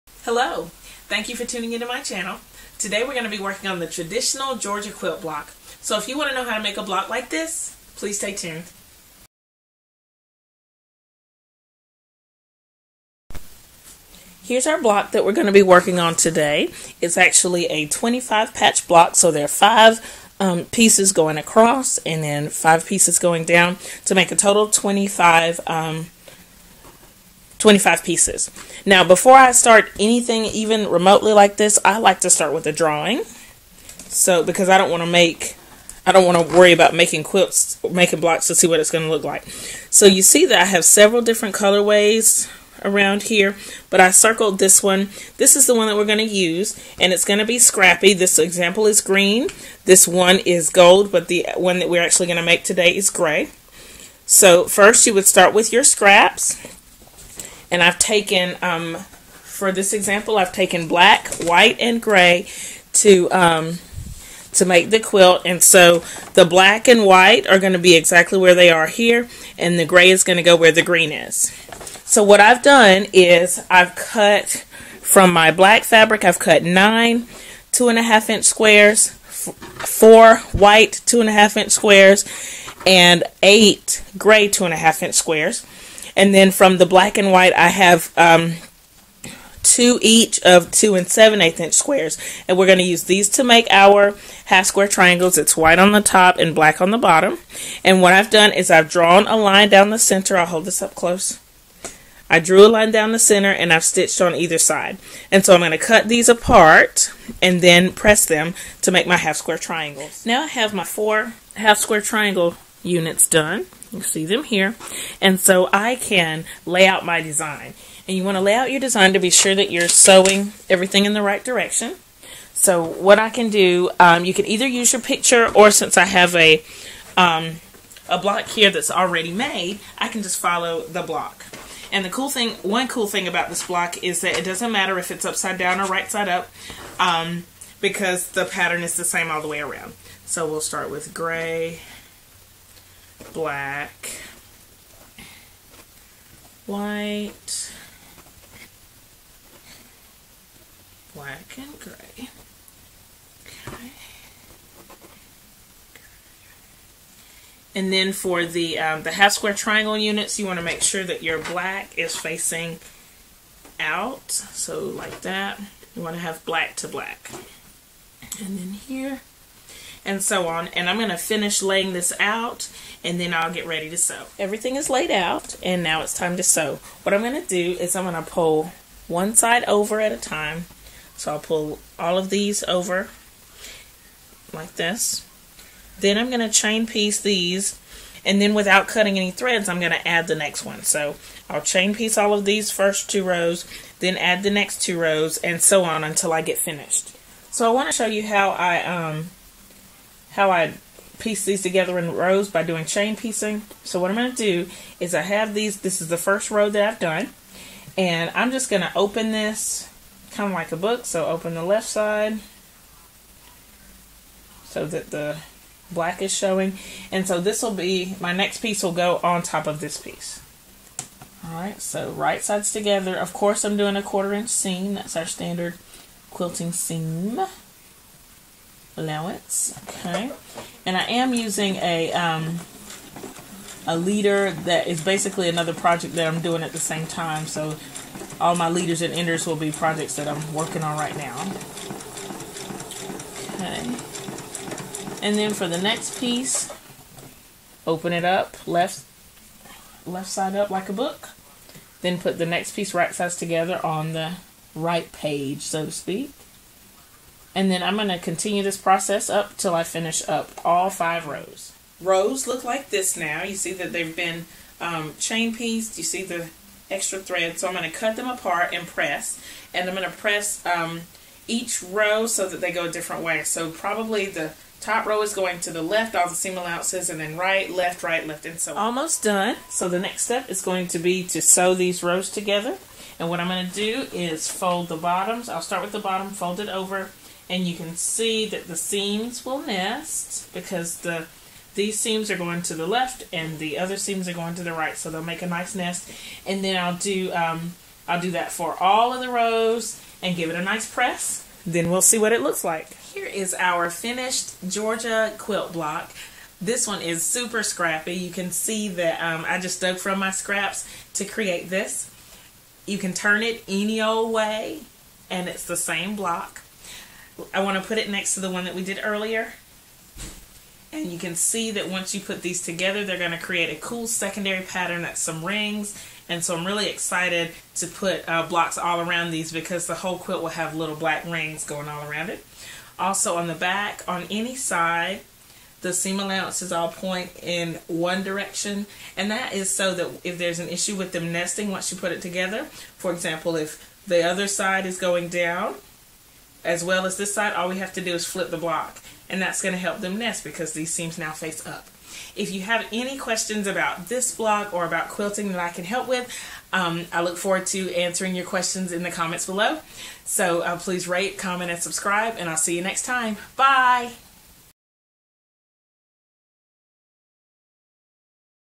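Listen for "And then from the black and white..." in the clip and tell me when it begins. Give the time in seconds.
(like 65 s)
86 s.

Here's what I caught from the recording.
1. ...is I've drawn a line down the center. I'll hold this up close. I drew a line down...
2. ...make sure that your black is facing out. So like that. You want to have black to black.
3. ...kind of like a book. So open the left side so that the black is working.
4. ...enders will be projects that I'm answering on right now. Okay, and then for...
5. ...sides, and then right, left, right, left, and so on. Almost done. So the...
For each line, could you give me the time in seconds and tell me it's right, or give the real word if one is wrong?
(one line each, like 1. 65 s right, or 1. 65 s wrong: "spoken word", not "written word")
1. 98 s right
2. 160 s right
3. 210 s wrong: "showing", not "working"
4. 239 s wrong: "working", not "answering"
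5. 276 s wrong: "allowances", not "sides".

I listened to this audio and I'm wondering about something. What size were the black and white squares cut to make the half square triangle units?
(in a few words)
2 7/8 inch.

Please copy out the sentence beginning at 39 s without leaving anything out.
So you see that I have several different colorways around here, but I circled this one.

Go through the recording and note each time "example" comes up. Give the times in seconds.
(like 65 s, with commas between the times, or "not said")
48 s, 59 s, 343 s.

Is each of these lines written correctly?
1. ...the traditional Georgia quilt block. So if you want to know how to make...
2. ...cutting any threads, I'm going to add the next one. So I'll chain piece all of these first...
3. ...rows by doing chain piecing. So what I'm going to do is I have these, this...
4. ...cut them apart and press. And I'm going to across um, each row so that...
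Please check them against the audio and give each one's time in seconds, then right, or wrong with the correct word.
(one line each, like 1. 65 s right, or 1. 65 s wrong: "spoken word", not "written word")
1. 3 s right
2. 188 s right
3. 202 s right
4. 267 s wrong: "press", not "across".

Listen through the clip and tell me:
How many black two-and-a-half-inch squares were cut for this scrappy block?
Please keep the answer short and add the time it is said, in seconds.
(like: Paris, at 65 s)
9, at 76 s.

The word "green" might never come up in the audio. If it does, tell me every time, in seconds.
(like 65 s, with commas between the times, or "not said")
49 s, 70 s.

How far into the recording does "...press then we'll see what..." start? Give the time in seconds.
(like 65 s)
300 s.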